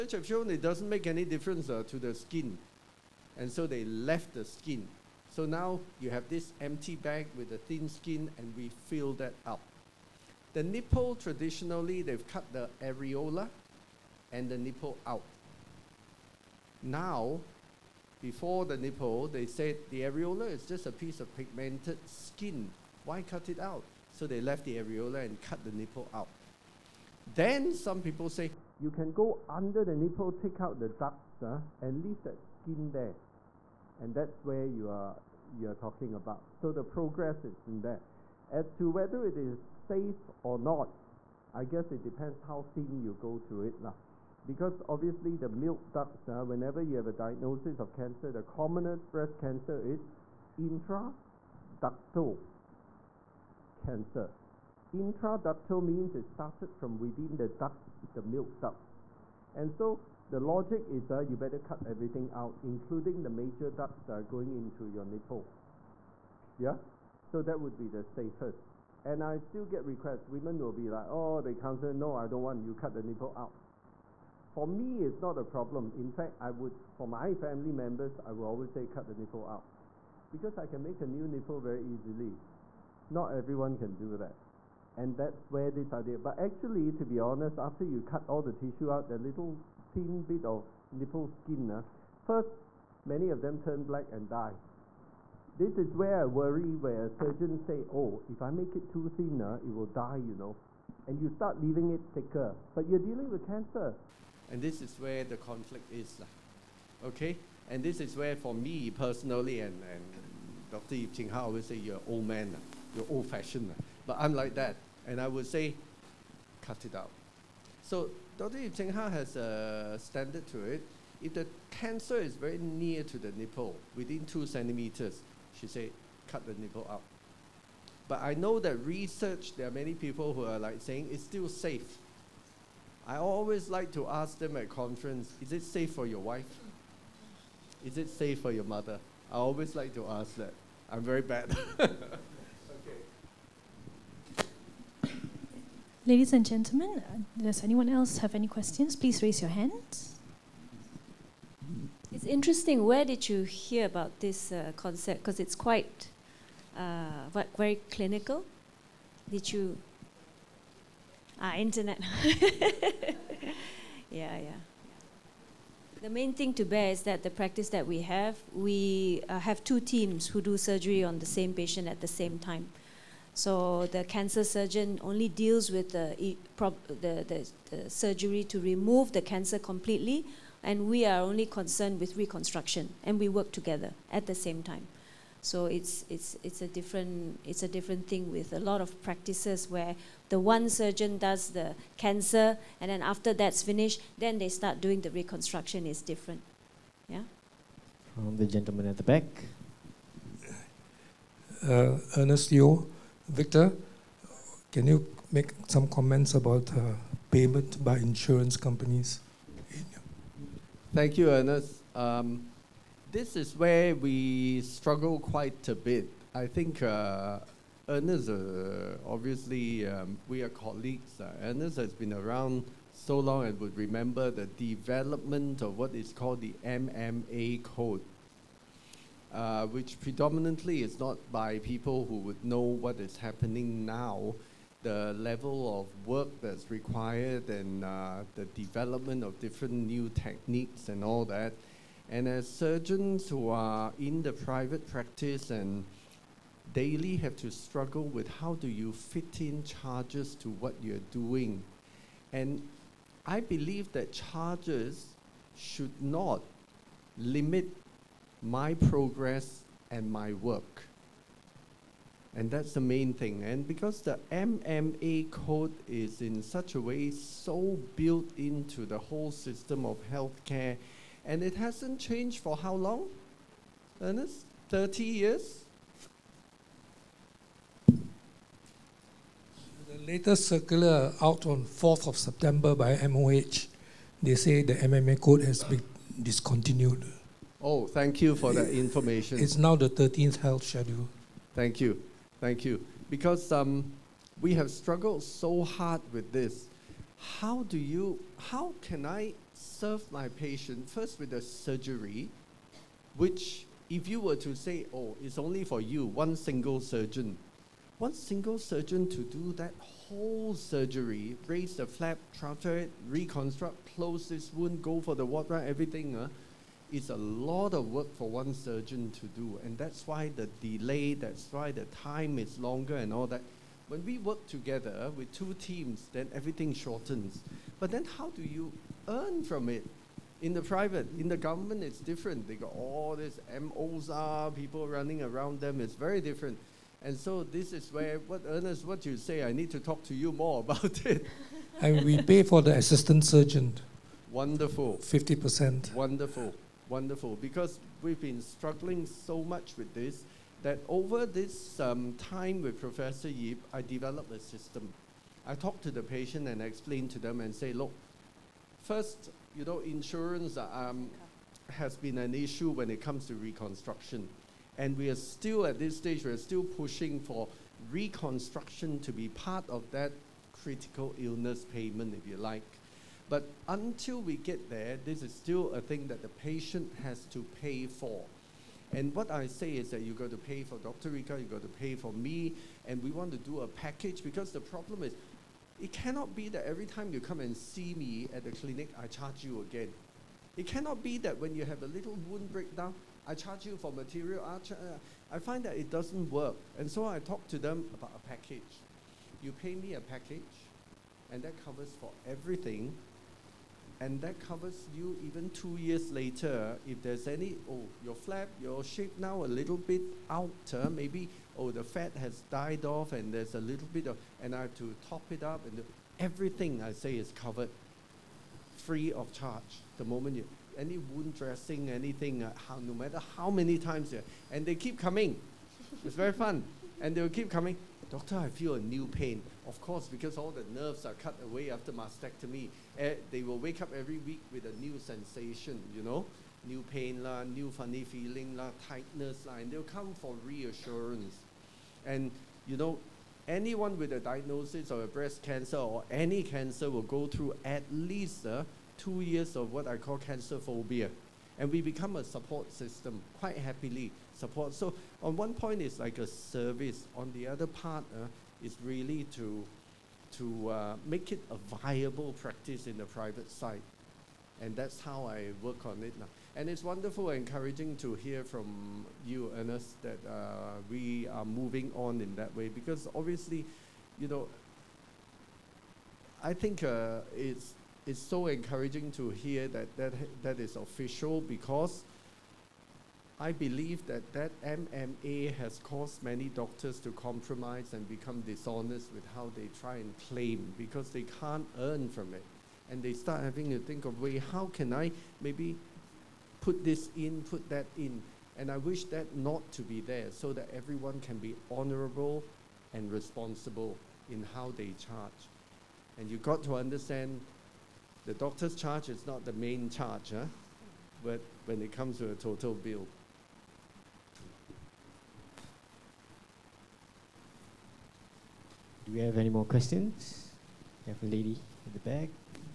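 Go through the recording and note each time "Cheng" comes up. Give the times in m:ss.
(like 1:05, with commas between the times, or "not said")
1:51, 1:58.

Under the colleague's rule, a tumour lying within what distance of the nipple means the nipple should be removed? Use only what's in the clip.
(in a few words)
2 centimeters.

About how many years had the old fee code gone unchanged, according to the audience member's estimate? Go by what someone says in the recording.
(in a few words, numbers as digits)
30 years.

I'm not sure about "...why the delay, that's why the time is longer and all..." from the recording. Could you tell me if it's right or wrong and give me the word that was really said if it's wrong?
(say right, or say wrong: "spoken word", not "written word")
right.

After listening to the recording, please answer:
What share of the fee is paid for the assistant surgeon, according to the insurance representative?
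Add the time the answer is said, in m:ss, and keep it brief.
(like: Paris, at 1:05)
50%, at 5:45.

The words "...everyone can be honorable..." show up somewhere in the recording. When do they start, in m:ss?
8:20.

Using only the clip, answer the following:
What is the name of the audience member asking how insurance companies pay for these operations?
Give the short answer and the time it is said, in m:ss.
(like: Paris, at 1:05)
Ernest Yeo, at 3:22.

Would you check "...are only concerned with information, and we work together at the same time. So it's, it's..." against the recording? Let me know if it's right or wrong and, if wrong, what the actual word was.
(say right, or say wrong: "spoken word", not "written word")
wrong: "reconstruction", not "information".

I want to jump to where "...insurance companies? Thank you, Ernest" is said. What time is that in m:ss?
3:27.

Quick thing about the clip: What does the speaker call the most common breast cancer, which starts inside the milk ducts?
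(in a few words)
intraductal cancer.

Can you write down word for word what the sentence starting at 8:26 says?
And you've got to understand the doctor's charge is not the main charge, huh?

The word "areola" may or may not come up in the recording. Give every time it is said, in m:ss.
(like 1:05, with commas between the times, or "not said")
0:12, 0:20, 0:24.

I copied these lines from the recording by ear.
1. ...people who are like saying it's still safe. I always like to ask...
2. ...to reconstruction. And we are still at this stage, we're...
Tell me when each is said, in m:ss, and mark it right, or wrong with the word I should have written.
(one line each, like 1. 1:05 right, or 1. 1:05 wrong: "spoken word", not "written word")
1. 2:09 right
2. 6:03 right.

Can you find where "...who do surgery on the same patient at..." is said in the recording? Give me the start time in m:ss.
2:50.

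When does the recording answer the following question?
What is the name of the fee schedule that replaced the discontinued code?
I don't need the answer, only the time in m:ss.
4:49.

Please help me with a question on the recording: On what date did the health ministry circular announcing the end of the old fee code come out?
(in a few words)
4th of September.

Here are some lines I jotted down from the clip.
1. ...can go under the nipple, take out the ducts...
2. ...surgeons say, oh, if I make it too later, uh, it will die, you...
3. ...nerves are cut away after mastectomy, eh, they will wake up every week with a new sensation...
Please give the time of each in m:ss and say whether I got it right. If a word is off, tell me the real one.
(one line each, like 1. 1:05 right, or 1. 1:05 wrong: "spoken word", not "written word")
1. 0:28 right
2. 1:37 wrong: "thinner", not "later"
3. 7:10 right.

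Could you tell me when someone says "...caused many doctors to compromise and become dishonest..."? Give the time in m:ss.
8:05.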